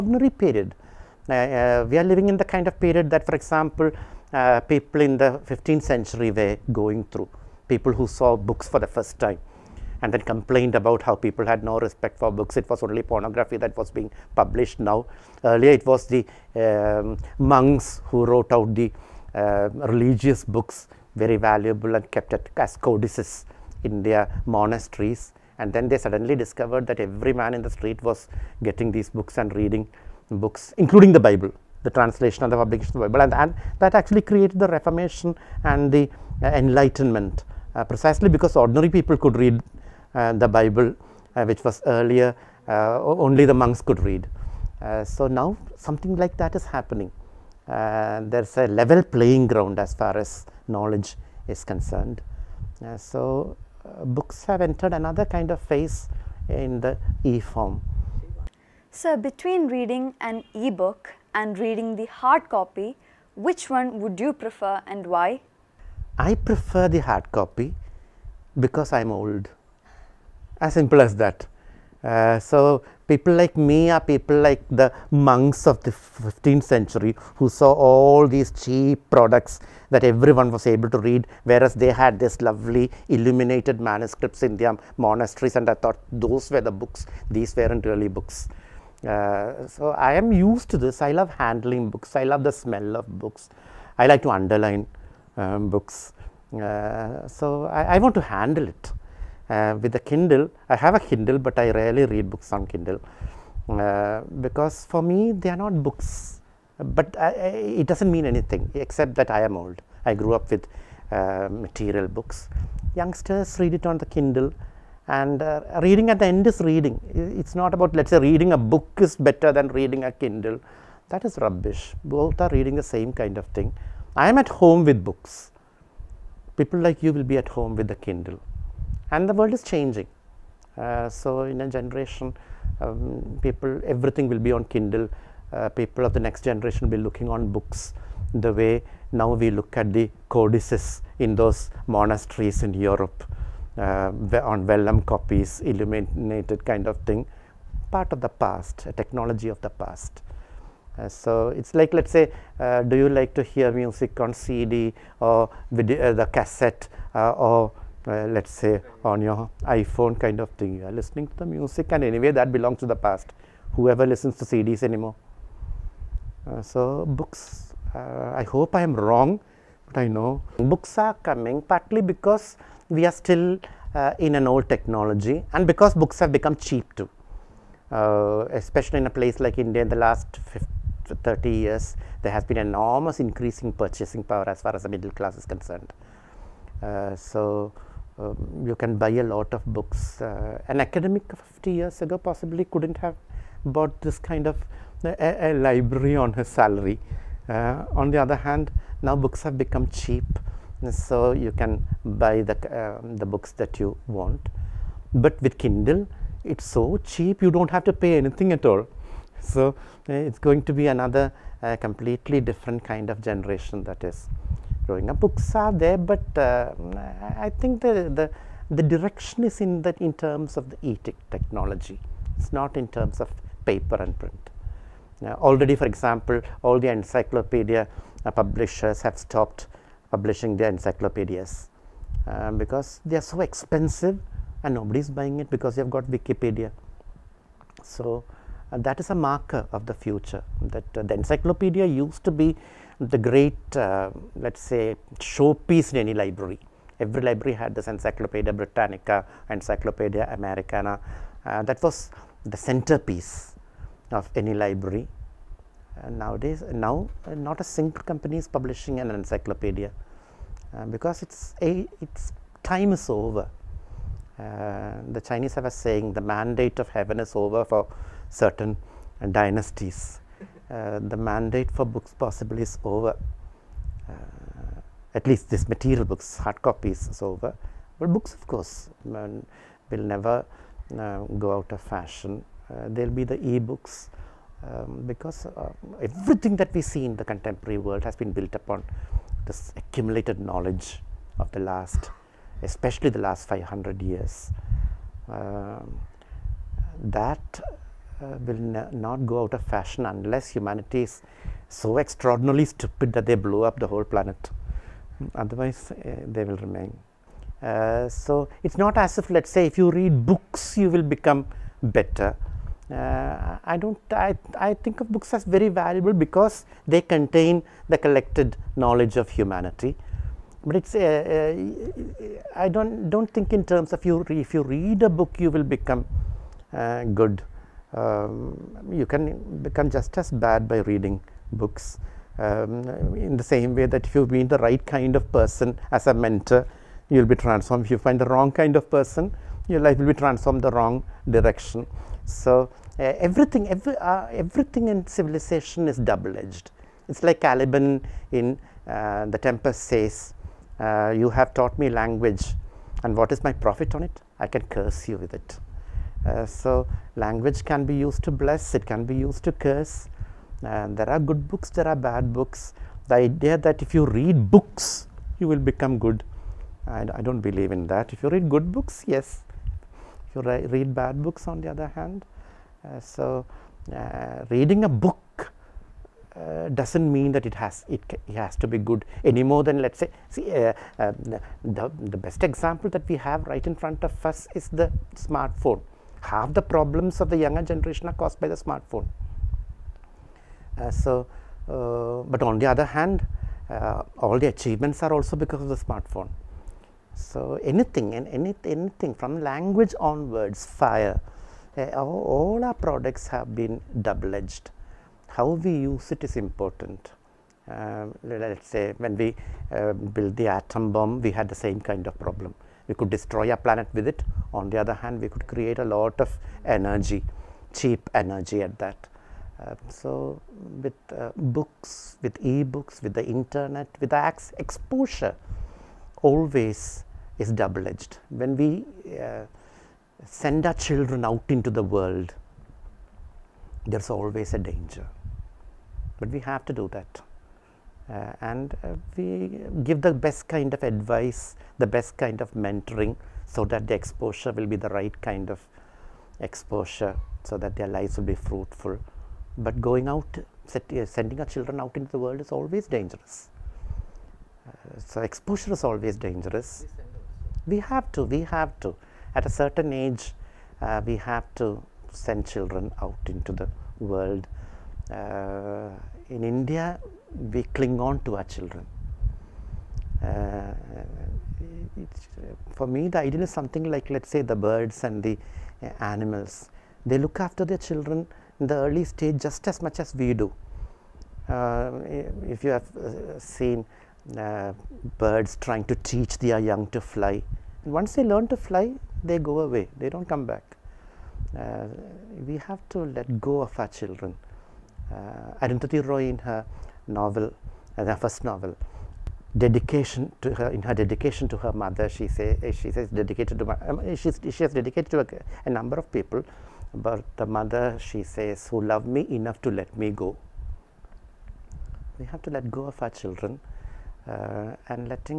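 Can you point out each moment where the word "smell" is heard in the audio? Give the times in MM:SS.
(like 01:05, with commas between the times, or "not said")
01:32.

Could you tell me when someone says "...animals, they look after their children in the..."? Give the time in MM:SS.
07:56.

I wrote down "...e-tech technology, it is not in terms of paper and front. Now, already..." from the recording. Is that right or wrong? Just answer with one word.
wrong.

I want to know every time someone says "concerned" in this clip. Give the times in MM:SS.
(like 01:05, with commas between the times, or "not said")
00:51, 03:05.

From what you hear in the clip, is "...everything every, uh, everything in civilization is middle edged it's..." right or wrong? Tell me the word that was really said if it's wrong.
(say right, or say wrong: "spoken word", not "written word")
wrong: "double", not "middle".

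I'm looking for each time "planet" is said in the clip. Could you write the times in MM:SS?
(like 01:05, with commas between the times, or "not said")
05:04, 06:53.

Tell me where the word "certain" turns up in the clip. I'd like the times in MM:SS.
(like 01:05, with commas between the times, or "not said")
04:28, 07:39.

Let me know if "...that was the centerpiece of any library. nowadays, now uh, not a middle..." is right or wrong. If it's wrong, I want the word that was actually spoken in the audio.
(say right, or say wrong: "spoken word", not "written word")
wrong: "single", not "middle".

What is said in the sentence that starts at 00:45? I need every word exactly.
so now something like that is happening.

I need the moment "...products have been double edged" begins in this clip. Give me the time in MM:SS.
06:42.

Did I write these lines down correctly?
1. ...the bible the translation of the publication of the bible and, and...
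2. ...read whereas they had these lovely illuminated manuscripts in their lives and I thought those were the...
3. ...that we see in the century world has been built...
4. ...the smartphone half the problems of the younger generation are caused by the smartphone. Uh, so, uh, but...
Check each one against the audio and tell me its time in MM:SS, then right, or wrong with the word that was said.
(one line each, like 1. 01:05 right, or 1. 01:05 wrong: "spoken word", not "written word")
1. 00:31 right
2. 01:20 wrong: "monasteries", not "lives"
3. 04:46 wrong: "contemporary", not "century"
4. 06:24 right.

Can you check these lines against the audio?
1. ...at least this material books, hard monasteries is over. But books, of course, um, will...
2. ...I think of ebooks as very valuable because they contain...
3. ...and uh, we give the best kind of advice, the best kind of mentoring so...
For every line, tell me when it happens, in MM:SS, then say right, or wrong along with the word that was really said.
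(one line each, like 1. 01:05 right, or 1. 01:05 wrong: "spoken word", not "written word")
1. 04:35 wrong: "copies", not "monasteries"
2. 05:14 wrong: "books", not "ebooks"
3. 07:18 right.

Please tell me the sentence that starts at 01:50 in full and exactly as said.
I grew up with uh, material books.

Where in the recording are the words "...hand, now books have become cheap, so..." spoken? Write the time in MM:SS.
03:18.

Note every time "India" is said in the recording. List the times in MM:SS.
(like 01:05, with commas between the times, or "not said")
02:59, 07:46.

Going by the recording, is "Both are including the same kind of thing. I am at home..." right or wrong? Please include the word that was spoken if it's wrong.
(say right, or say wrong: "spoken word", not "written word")
wrong: "reading", not "including".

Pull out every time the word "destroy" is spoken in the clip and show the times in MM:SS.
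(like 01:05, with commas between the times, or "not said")
06:53.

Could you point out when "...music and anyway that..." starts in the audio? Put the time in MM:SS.
02:41.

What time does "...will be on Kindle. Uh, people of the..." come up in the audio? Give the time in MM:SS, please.
02:14.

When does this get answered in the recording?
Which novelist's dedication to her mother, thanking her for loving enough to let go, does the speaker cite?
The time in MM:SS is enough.
08:15.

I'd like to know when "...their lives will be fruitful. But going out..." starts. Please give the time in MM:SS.
07:27.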